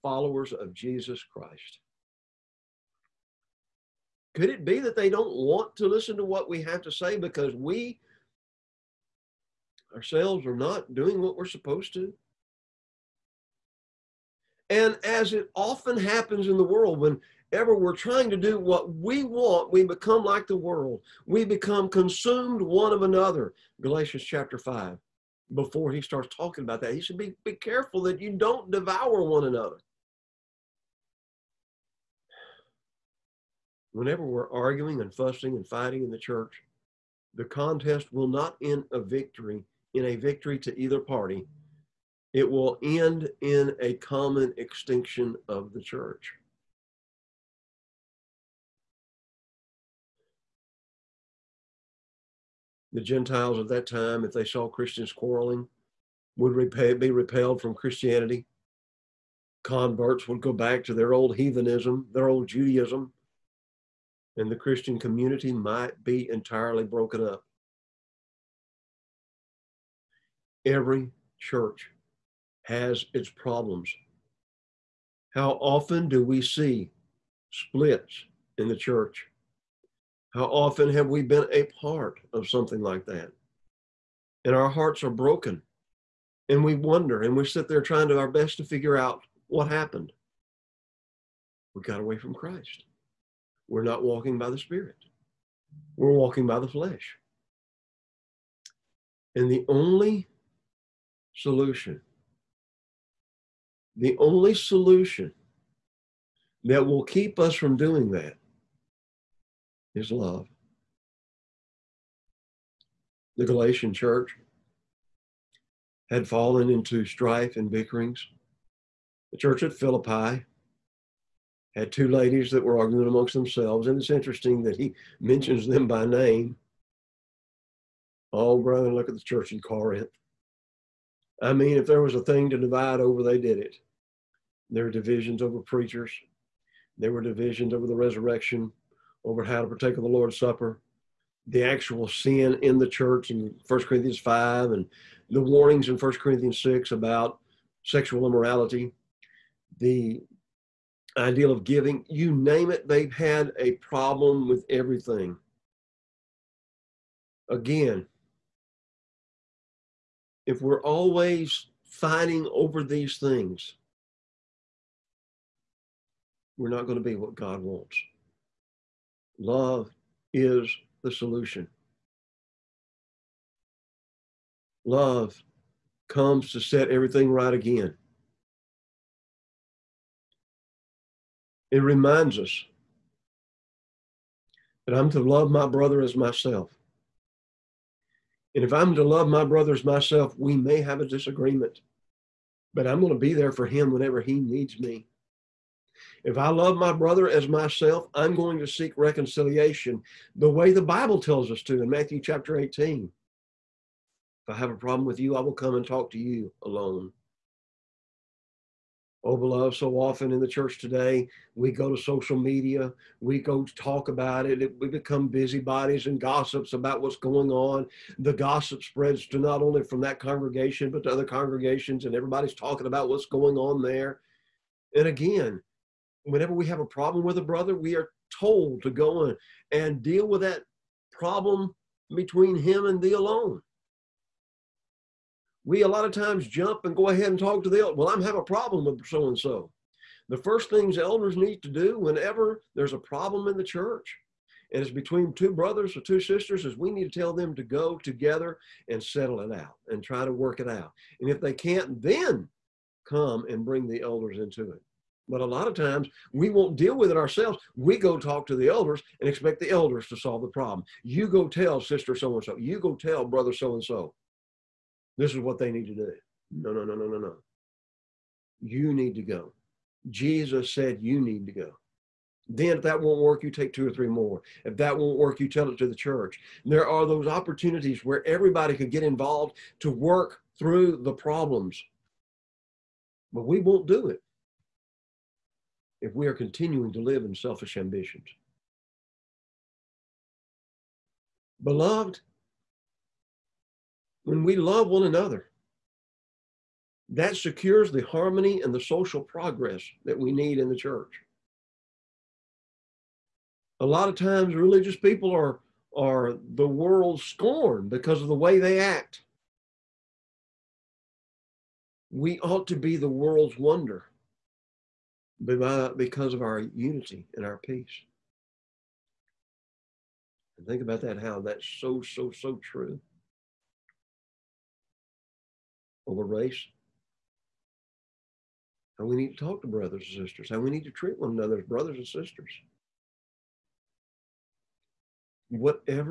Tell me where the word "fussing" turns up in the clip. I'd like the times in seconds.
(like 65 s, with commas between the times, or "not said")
35 s.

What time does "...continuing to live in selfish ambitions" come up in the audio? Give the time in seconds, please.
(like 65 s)
286 s.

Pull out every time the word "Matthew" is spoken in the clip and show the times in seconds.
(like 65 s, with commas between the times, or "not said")
201 s.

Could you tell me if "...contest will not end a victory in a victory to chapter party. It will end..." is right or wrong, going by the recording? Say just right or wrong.
wrong.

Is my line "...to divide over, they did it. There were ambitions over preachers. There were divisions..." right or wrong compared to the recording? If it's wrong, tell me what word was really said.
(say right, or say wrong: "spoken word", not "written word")
wrong: "divisions", not "ambitions".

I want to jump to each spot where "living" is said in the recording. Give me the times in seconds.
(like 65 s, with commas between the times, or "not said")
not said.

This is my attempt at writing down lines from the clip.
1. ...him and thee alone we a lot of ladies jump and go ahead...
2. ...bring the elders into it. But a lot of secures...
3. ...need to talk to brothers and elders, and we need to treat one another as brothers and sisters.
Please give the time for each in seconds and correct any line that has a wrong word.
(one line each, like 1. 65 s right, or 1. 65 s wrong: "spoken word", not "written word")
1. 232 s wrong: "times", not "ladies"
2. 253 s wrong: "times", not "secures"
3. 329 s wrong: "sisters", not "elders".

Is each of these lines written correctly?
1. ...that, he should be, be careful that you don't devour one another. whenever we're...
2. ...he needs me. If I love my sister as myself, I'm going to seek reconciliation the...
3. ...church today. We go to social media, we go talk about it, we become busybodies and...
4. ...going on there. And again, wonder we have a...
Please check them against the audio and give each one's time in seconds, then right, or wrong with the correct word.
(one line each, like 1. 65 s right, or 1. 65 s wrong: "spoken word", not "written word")
1. 26 s right
2. 194 s wrong: "brother", not "sister"
3. 210 s right
4. 223 s wrong: "whenever", not "wonder".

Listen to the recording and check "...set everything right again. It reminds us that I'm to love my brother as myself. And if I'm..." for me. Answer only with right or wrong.
right.